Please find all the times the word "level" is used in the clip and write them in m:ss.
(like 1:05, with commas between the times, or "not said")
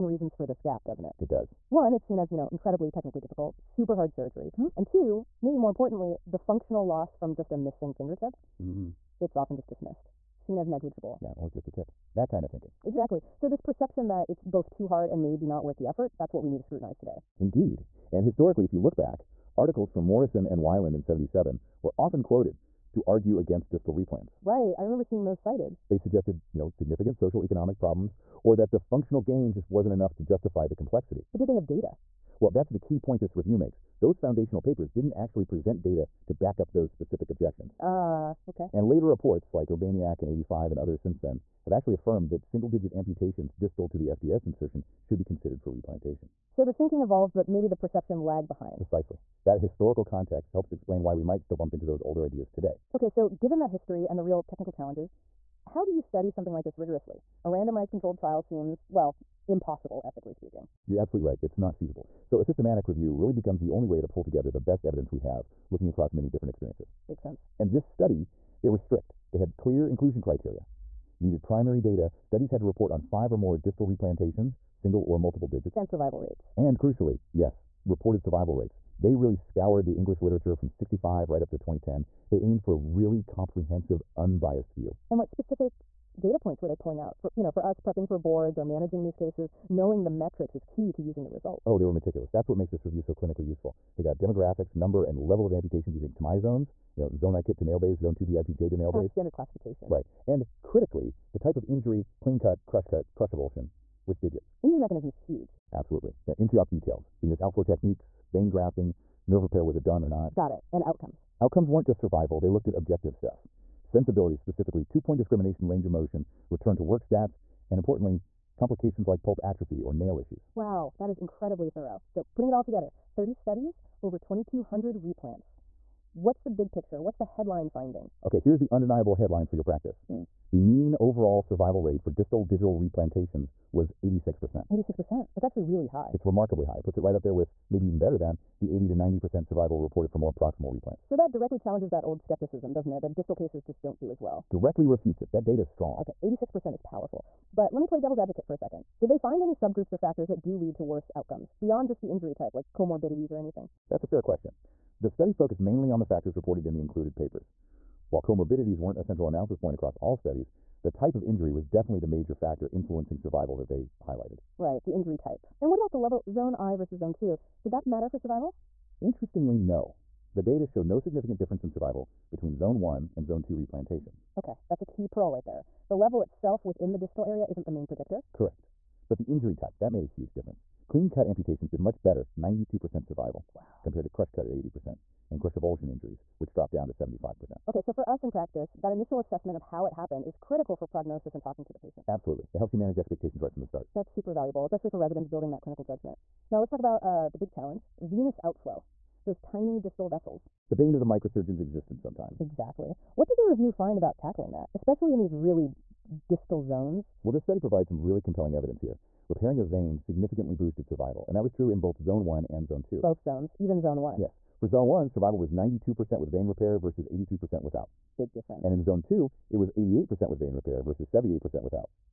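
1:35, 2:45, 2:55.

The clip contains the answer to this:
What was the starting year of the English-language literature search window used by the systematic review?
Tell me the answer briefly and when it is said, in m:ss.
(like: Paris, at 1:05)
1965, at 1:20.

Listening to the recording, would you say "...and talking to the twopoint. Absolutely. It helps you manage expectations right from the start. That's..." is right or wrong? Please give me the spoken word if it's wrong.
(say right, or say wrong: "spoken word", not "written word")
wrong: "patient", not "twopoint".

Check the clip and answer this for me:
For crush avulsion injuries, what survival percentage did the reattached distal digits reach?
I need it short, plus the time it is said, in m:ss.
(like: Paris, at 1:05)
75%, at 3:06.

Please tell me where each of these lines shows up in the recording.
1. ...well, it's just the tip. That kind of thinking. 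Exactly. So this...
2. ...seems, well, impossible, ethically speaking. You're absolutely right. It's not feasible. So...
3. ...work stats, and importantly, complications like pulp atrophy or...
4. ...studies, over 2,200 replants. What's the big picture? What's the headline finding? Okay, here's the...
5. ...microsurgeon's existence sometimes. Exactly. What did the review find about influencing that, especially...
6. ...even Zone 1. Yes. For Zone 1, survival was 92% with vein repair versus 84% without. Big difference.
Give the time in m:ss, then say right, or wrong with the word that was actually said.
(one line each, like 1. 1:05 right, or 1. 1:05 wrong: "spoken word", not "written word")
1. 0:11 right
2. 0:58 right
3. 1:56 right
4. 2:03 right
5. 3:21 wrong: "tackling", not "influencing"
6. 3:33 wrong: "83", not "84".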